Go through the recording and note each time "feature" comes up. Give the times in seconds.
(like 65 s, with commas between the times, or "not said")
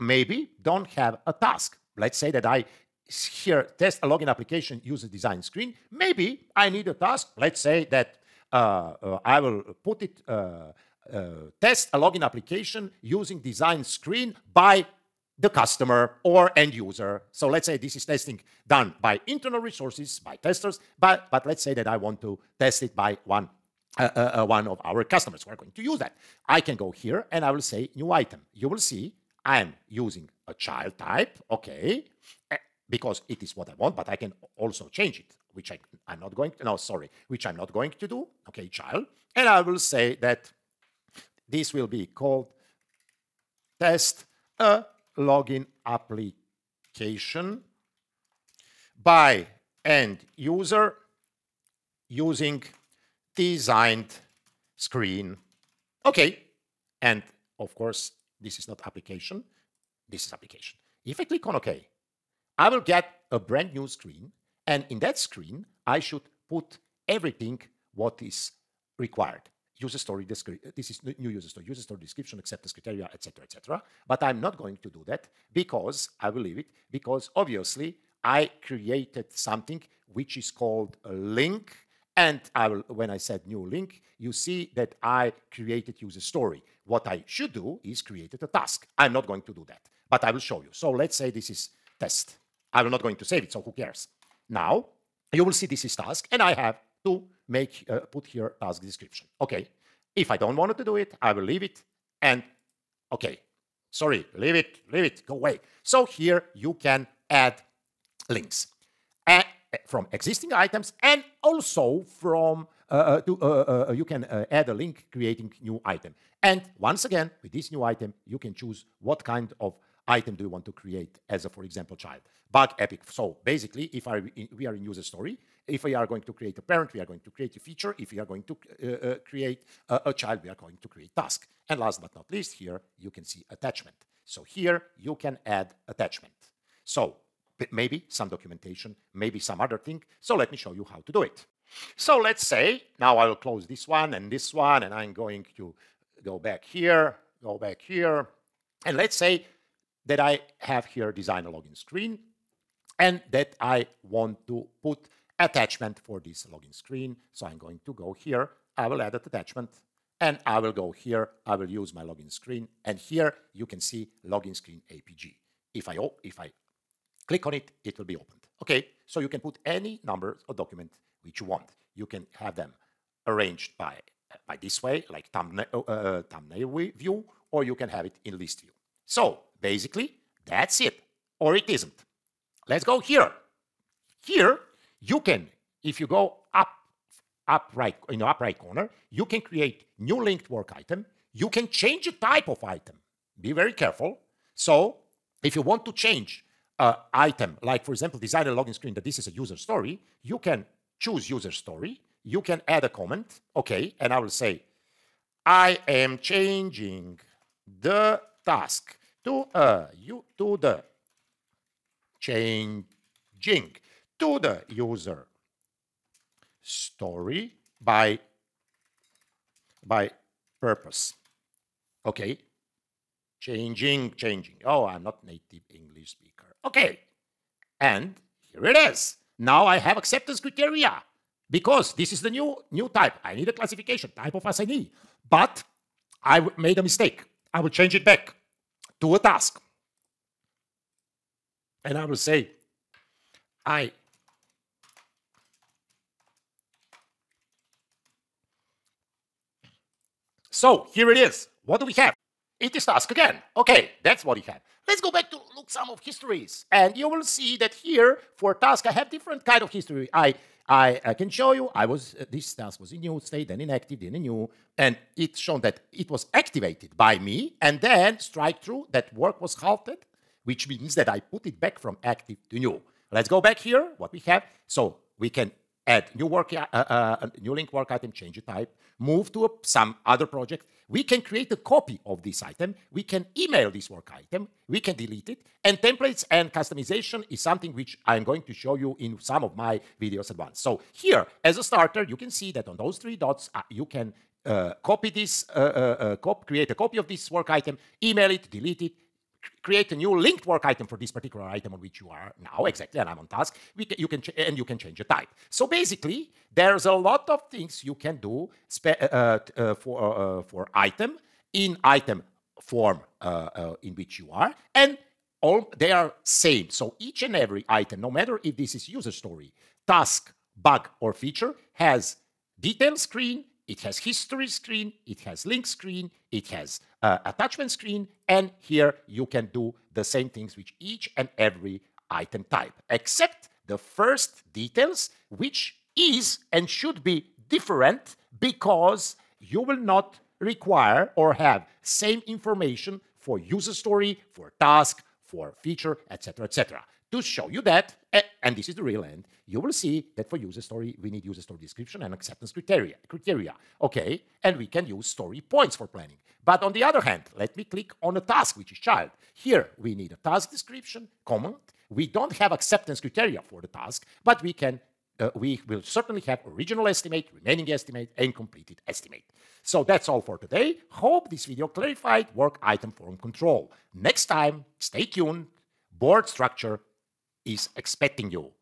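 127 s, 321 s, 345 s.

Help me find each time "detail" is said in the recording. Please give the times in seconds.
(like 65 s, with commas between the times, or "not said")
322 s, 334 s.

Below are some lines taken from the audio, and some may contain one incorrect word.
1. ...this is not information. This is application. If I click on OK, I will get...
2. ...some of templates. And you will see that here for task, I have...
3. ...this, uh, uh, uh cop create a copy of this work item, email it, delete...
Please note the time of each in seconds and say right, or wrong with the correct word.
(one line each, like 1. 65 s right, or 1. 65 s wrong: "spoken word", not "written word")
1. 58 s wrong: "application", not "information"
2. 255 s wrong: "histories", not "templates"
3. 295 s right.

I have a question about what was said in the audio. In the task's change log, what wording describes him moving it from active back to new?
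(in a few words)
work was halted.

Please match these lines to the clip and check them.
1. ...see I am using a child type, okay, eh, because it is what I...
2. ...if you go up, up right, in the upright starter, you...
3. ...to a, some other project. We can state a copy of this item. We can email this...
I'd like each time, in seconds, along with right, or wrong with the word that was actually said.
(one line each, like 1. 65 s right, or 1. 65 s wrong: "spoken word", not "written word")
1. 28 s right
2. 185 s wrong: "corner", not "starter"
3. 279 s wrong: "create", not "state".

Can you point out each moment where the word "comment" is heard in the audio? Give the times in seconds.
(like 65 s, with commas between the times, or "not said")
202 s, 361 s.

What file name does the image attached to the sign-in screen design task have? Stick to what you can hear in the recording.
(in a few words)
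login screen JPG.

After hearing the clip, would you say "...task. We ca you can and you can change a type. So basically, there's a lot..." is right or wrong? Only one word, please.
right.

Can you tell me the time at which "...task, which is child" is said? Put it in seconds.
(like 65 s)
358 s.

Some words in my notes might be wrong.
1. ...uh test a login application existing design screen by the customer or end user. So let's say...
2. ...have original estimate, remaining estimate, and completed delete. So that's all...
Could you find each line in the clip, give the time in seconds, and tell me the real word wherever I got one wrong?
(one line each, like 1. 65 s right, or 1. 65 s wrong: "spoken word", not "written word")
1. 10 s wrong: "using", not "existing"
2. 366 s wrong: "estimate", not "delete".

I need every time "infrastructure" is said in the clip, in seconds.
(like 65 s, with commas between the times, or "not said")
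not said.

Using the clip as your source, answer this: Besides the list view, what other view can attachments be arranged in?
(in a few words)
Thumbnail view.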